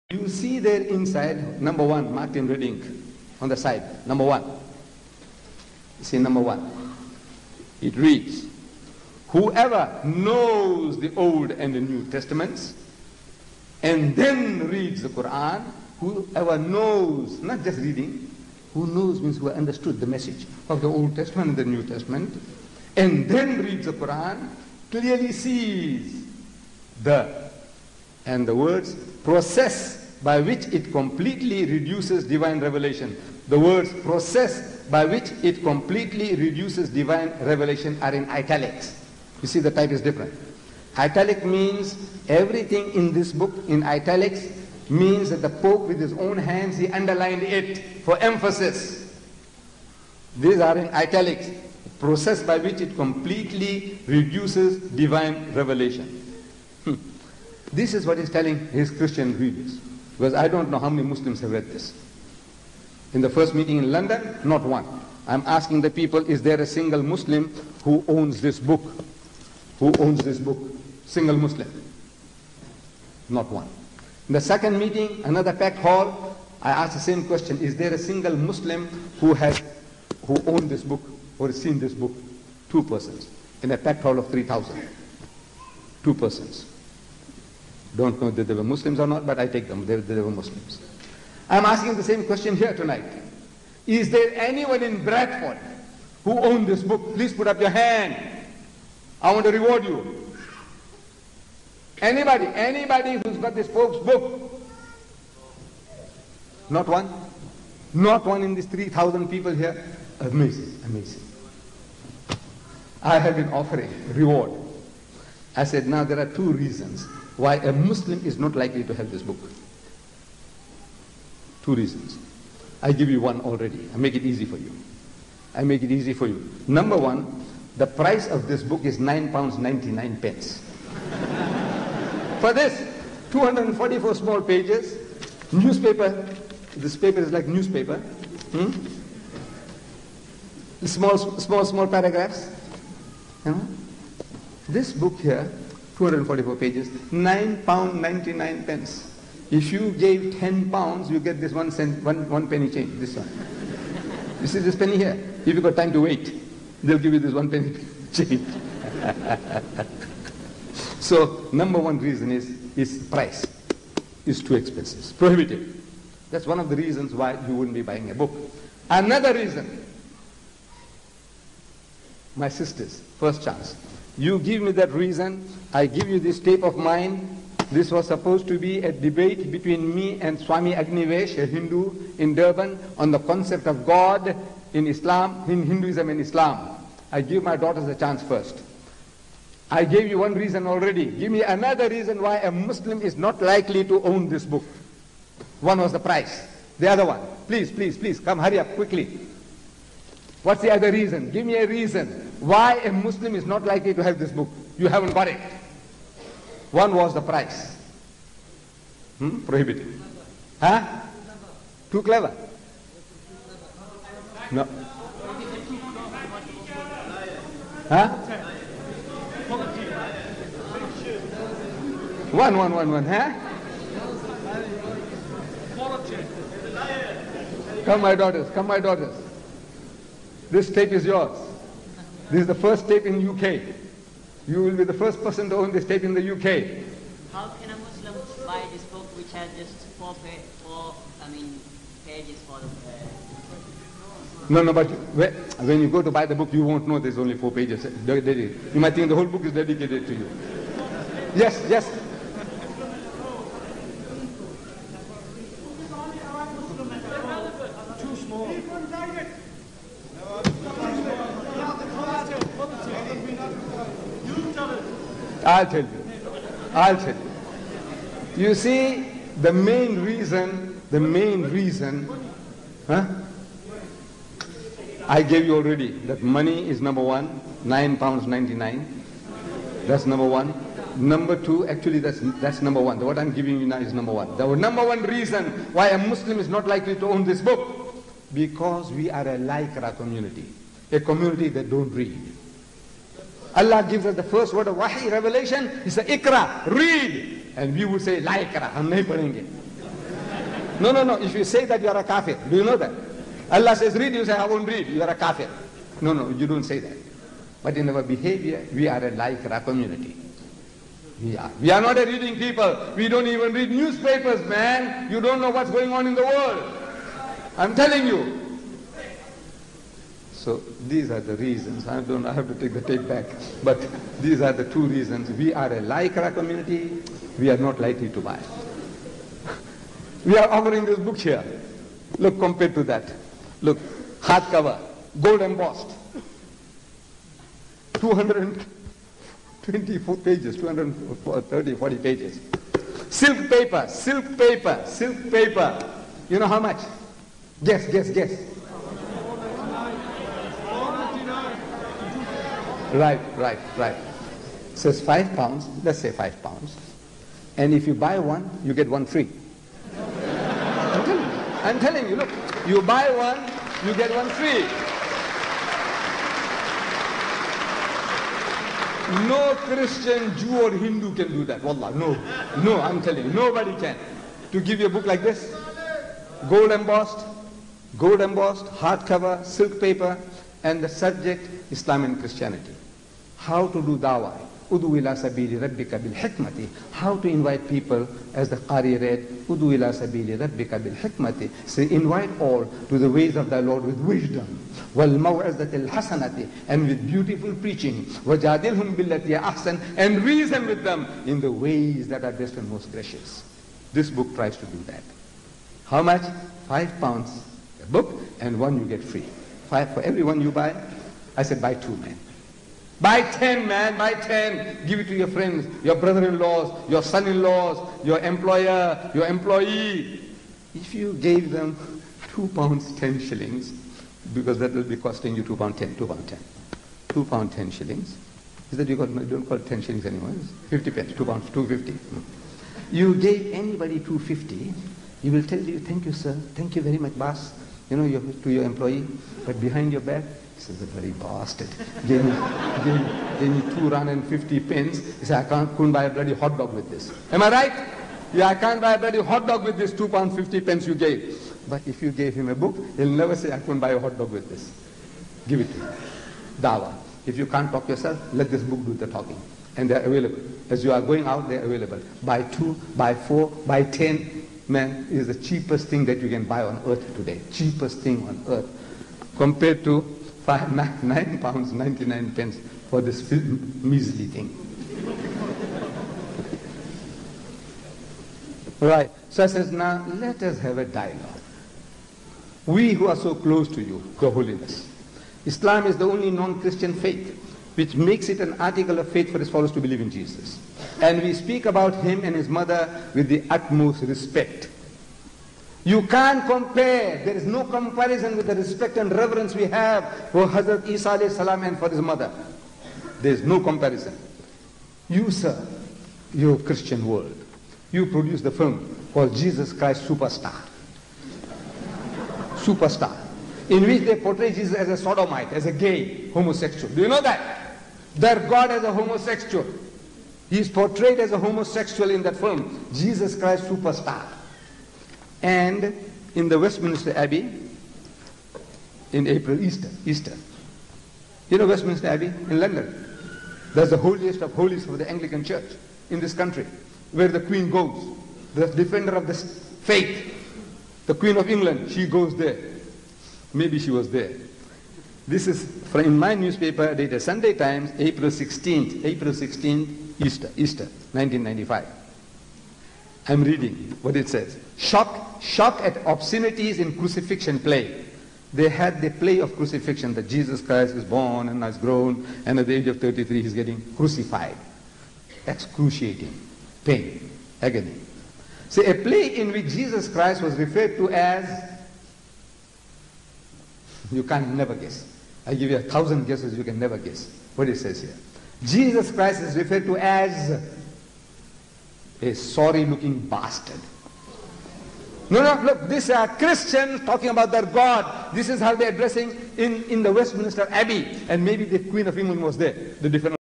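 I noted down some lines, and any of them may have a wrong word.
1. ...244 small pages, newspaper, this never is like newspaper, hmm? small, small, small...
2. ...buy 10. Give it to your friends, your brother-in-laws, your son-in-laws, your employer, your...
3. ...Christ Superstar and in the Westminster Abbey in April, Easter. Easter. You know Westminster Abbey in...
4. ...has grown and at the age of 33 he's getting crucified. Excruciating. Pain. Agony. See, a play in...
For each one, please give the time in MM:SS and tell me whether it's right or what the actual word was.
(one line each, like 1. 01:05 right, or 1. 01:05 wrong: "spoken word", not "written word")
1. 02:13 wrong: "paper", not "never"
2. 06:53 right
3. 08:43 right
4. 09:21 right.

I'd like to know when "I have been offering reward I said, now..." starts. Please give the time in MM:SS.
01:53.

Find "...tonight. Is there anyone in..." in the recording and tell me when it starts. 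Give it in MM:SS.
01:32.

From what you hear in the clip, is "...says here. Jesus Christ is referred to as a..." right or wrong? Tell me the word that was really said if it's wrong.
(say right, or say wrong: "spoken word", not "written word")
right.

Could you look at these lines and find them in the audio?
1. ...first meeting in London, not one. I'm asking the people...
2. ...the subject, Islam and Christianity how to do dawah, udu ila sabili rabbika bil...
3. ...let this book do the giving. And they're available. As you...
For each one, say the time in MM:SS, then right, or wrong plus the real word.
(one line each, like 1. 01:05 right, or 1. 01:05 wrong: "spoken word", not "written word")
1. 01:03 right
2. 06:20 right
3. 07:38 wrong: "talking", not "giving".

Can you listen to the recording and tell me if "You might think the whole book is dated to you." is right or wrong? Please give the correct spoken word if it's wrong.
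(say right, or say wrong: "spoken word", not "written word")
wrong: "dedicated", not "dated".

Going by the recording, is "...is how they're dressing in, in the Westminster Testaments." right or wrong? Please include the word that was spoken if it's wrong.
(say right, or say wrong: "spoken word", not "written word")
wrong: "Abbey", not "Testaments".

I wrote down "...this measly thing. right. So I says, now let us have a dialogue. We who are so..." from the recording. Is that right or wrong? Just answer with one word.
right.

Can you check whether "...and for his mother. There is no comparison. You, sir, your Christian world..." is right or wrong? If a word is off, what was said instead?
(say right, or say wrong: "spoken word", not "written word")
right.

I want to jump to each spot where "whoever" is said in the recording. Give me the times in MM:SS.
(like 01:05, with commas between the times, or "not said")
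00:09, 00:16.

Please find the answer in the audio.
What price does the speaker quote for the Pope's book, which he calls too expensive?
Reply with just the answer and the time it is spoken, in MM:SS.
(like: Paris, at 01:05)
£9.99, at 02:08.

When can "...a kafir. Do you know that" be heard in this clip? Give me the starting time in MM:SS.
05:01.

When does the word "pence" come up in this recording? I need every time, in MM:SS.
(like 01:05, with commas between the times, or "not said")
02:10, 02:28, 07:10, 07:24, 07:30, 07:52.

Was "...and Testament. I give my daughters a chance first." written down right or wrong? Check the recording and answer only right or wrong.
wrong.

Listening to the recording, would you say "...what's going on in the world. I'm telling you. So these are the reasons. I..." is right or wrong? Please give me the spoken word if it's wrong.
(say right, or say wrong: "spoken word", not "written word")
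right.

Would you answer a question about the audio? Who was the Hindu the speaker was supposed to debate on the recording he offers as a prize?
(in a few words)
Swami Agnivesh.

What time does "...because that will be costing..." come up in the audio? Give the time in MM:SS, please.
07:04.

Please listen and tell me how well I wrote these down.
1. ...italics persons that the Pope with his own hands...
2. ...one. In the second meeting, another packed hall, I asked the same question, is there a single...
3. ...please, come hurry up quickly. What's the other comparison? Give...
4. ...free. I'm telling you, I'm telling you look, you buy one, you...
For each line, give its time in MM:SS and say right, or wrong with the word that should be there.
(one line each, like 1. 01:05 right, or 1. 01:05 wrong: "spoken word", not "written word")
1. 00:43 wrong: "means", not "persons"
2. 01:13 right
3. 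03:17 wrong: "reason", not "comparison"
4. 05:59 right.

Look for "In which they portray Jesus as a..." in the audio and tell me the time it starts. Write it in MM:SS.
08:33.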